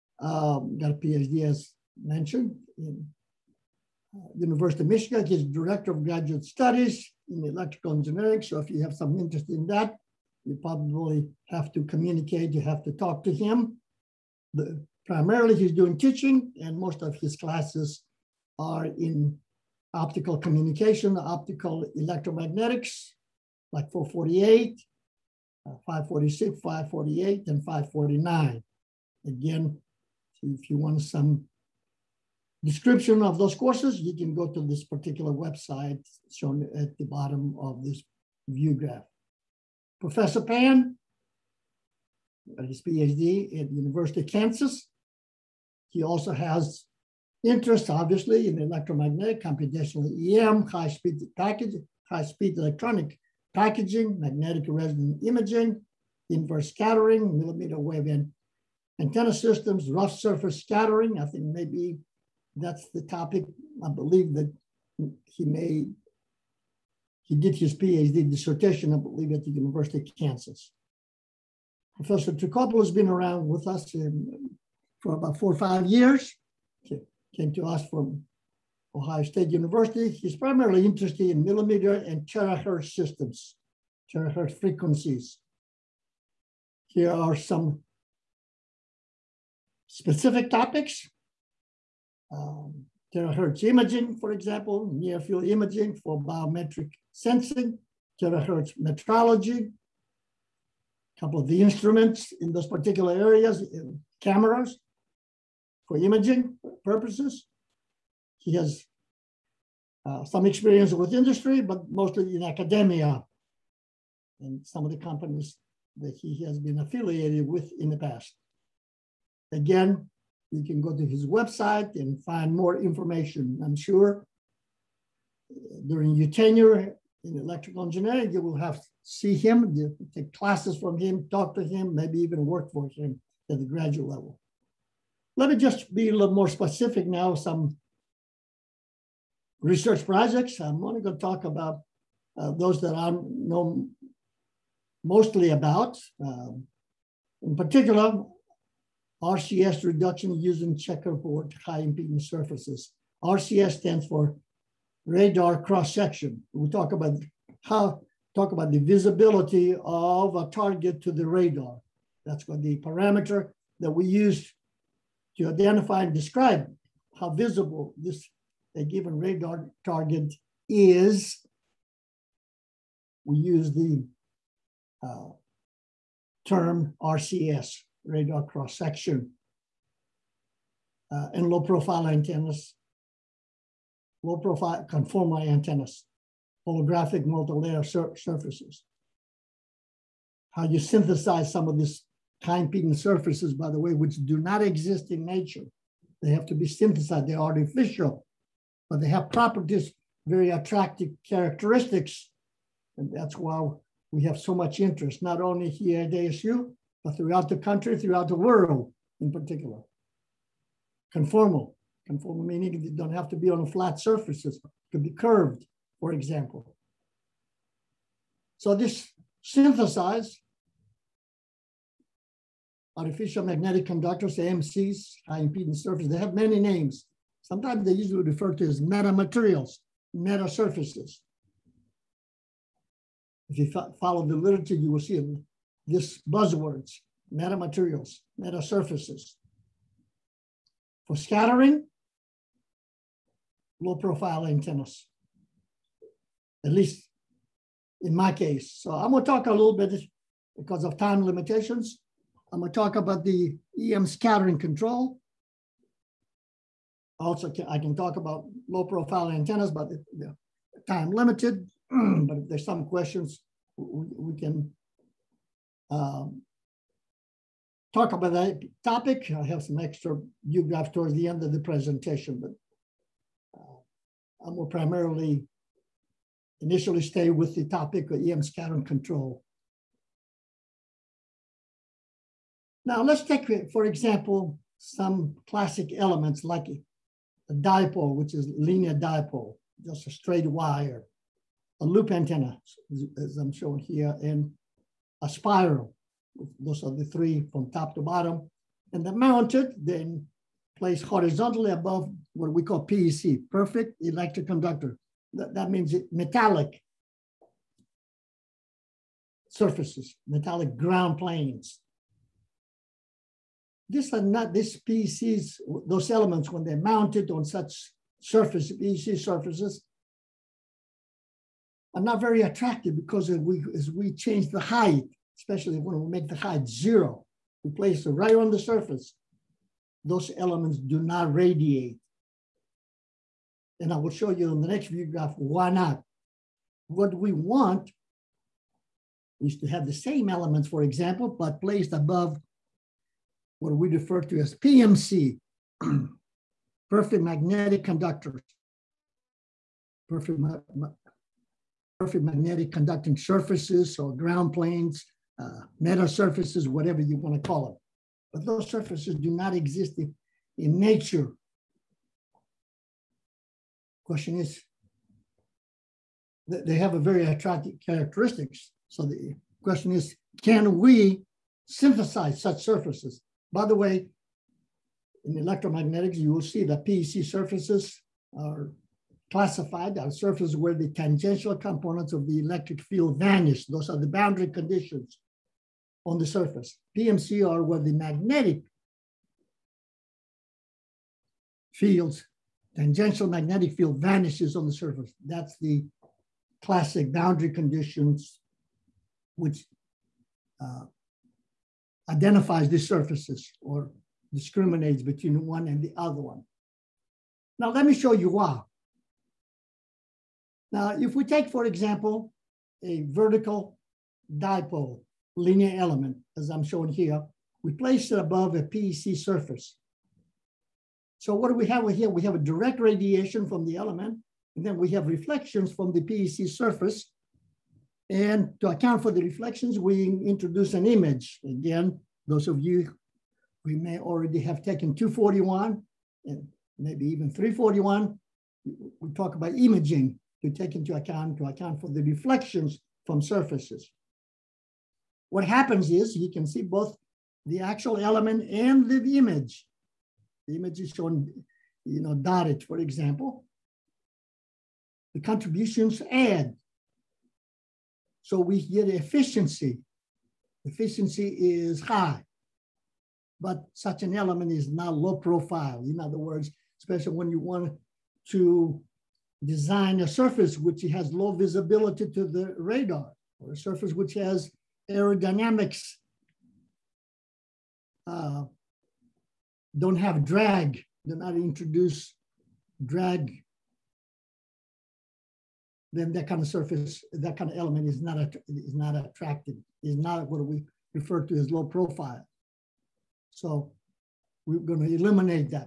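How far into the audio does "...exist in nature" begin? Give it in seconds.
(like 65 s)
194 s.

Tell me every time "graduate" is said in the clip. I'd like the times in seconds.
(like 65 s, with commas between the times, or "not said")
6 s, 133 s.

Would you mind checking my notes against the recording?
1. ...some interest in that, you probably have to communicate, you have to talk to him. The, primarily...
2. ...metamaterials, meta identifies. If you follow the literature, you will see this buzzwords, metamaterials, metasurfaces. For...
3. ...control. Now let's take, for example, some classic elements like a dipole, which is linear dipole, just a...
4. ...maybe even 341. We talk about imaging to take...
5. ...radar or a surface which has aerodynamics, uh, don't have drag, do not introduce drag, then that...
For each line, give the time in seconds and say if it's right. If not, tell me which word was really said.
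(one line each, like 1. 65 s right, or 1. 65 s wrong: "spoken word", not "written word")
1. 8 s right
2. 228 s wrong: "surfaces", not "identifies"
3. 278 s right
4. 436 s right
5. 472 s right.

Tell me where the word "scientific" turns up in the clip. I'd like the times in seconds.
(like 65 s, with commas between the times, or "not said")
not said.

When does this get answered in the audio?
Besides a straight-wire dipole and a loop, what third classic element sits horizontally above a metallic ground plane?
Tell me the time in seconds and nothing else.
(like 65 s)
295 s.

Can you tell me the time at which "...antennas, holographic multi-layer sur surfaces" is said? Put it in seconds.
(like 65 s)
185 s.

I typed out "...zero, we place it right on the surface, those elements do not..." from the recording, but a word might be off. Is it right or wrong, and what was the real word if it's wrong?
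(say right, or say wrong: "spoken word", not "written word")
right.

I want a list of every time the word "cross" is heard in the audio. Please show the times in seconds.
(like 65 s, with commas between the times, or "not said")
155 s, 178 s.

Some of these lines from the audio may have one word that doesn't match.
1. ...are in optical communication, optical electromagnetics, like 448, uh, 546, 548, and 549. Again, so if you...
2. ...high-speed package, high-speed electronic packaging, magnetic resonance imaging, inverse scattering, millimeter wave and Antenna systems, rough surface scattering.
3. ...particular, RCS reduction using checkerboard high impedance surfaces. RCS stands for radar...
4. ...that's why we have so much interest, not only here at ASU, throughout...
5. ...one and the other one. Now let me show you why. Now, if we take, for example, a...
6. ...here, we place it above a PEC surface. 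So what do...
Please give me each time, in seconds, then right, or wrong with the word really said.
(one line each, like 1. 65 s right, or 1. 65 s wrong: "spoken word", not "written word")
1. 18 s right
2. 50 s right
3. 147 s right
4. 203 s right
5. 405 s right
6. 416 s right.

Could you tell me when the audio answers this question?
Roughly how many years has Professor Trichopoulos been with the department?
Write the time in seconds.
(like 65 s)
75 s.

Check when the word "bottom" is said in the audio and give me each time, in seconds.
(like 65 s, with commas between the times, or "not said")
37 s, 298 s.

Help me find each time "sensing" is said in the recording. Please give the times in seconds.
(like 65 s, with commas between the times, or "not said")
97 s.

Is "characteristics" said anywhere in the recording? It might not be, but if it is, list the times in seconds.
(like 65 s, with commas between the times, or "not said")
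201 s, 367 s.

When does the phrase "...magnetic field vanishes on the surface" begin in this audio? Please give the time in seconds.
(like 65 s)
393 s.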